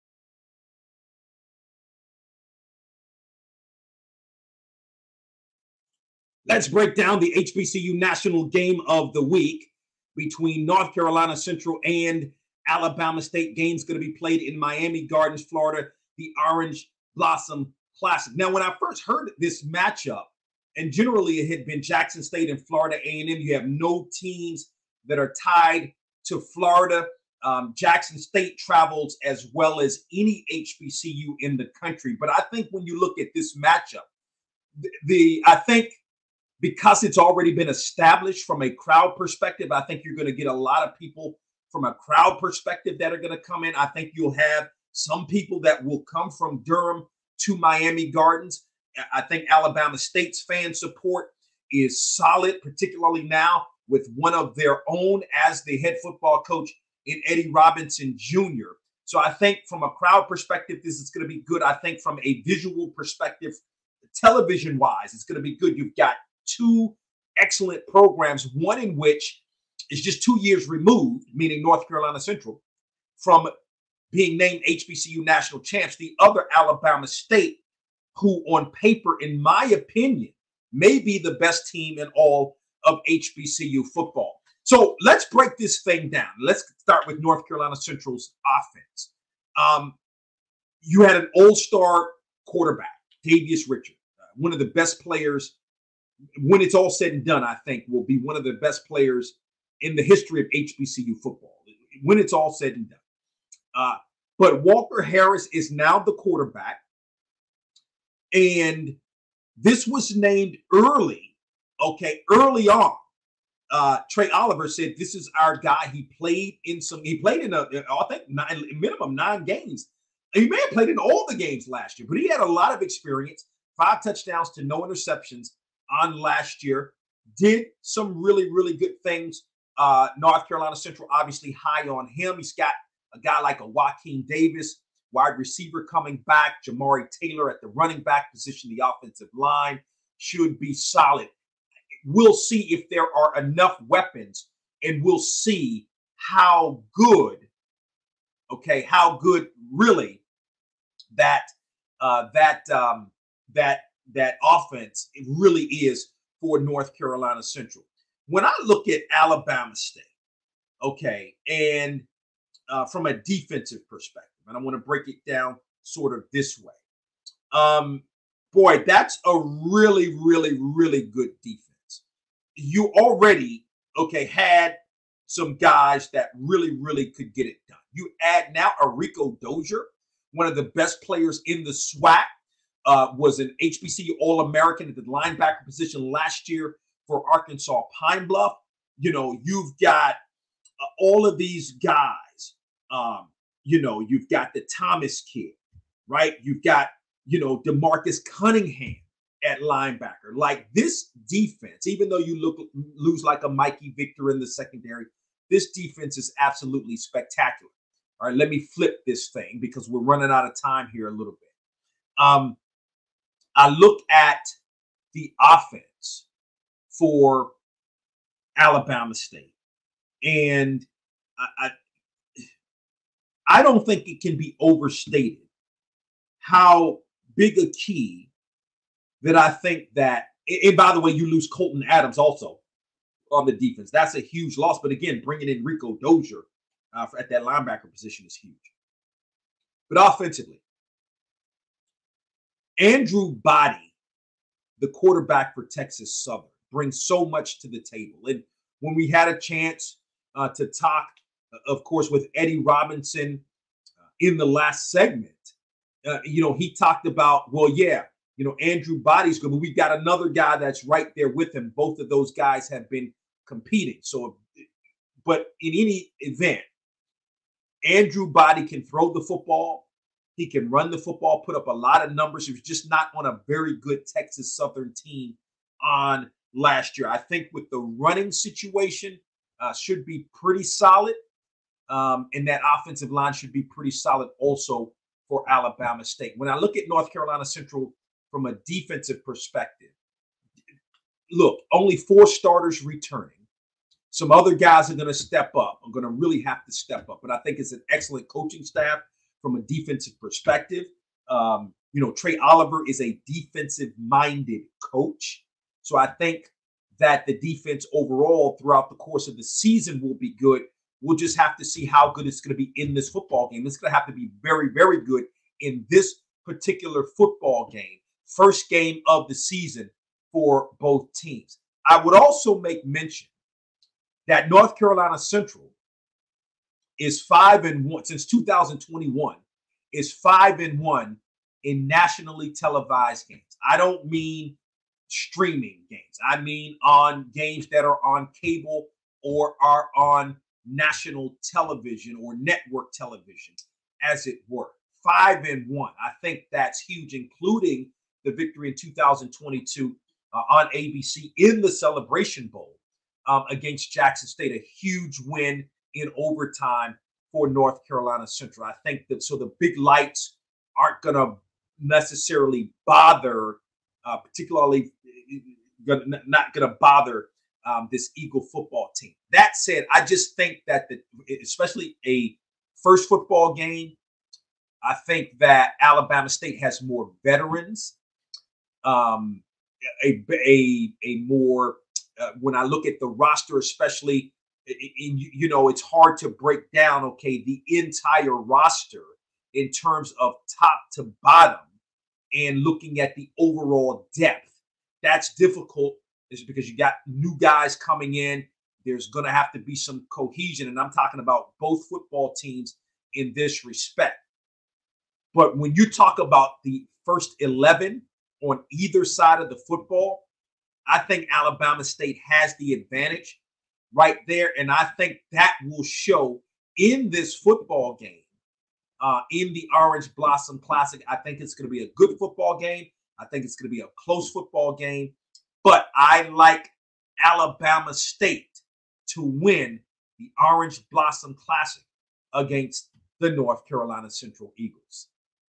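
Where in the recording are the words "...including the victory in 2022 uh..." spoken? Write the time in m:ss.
5:47.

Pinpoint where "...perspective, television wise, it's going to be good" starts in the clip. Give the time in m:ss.
1:02.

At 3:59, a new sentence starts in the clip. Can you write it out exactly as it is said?
But offensively, Andrew Body, the quarterback for Texas Southern, brings so much to the table.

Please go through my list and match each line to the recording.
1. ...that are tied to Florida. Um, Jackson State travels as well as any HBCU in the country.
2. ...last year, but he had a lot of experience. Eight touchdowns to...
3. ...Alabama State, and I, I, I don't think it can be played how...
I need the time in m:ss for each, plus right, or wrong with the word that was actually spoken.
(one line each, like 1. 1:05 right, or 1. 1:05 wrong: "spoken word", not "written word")
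1. 0:25 right
2. 2:01 wrong: "Five", not "Eight"
3. 3:38 wrong: "overstated", not "played".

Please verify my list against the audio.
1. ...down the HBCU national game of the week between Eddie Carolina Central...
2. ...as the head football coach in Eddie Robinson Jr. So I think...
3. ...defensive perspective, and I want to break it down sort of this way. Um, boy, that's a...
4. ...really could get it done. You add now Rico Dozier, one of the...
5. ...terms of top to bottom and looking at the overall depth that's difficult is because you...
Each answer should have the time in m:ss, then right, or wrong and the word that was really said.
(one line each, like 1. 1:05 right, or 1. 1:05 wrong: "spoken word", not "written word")
1. 0:06 wrong: "North", not "Eddie"
2. 0:55 right
3. 2:43 right
4. 2:56 right
5. 6:29 right.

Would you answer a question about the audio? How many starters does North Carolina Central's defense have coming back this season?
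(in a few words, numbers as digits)
4.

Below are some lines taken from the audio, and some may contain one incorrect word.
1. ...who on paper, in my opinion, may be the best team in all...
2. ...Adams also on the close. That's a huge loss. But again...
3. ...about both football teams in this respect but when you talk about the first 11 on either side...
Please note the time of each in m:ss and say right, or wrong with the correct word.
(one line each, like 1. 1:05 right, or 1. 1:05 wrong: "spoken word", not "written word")
1. 1:18 right
2. 3:51 wrong: "defense", not "close"
3. 6:41 right.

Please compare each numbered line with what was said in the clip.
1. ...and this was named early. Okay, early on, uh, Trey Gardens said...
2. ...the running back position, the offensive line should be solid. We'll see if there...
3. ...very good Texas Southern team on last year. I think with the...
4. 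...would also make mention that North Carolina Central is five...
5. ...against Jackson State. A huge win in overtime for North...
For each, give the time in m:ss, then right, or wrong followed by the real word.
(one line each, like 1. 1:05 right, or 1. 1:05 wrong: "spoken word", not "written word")
1. 1:48 wrong: "Oliver", not "Gardens"
2. 2:17 right
3. 4:33 right
4. 5:22 right
5. 5:53 right.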